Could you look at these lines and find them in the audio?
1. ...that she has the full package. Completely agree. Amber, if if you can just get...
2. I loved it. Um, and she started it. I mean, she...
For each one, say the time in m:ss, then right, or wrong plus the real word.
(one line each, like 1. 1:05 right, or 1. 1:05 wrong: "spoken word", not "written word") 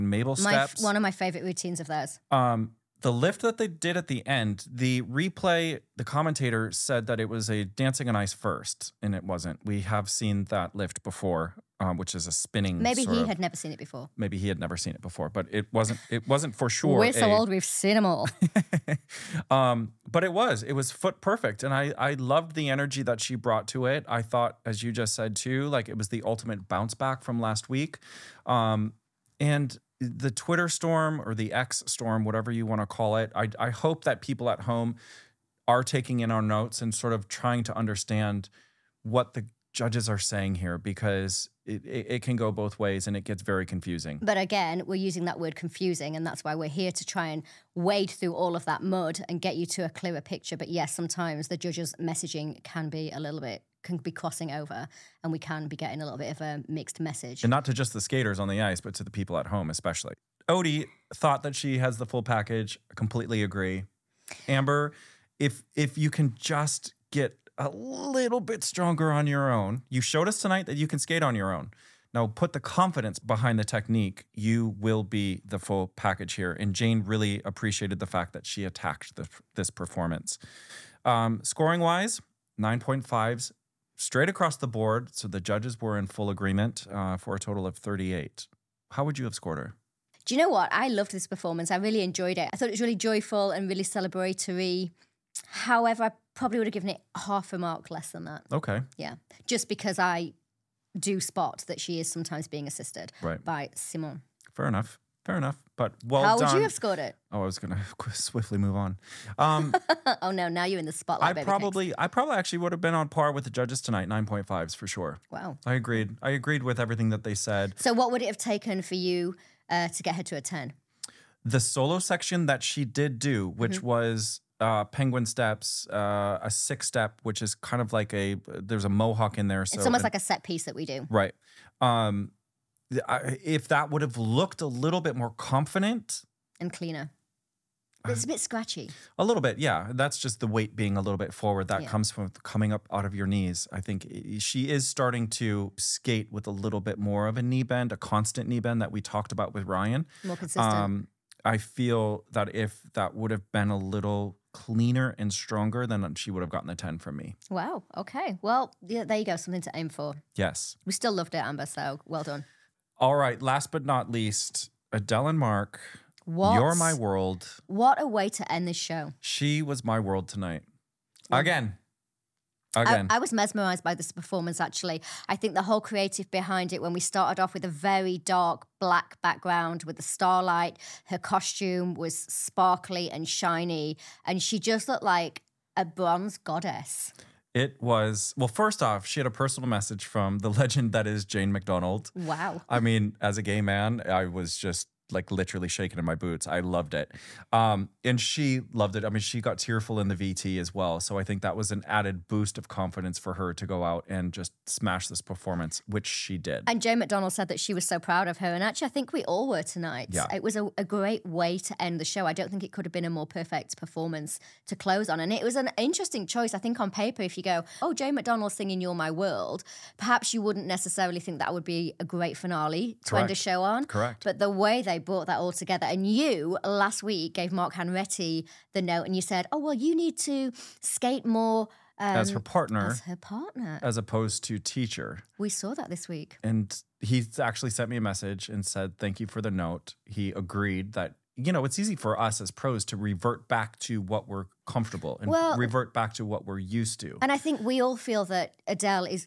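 1. 1:01 right
2. 3:16 wrong: "loved", not "started".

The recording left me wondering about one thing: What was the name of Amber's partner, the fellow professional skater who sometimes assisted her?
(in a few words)
Simon.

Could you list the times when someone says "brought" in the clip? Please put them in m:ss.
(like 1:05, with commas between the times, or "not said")
0:23, 3:44.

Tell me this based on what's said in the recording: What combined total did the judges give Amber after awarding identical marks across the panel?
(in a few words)
38.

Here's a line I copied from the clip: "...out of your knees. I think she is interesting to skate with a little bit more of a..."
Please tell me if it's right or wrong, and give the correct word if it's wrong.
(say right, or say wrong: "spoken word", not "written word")
wrong: "starting", not "interesting".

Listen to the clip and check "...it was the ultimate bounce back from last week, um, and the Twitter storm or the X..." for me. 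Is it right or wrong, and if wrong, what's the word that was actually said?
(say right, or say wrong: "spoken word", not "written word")
right.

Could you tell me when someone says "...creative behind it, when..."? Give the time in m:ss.
2:55.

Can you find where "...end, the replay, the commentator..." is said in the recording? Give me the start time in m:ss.
0:04.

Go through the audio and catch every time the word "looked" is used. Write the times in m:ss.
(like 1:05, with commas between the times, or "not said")
2:14, 3:04.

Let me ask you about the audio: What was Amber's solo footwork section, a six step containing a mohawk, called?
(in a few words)
penguin steps.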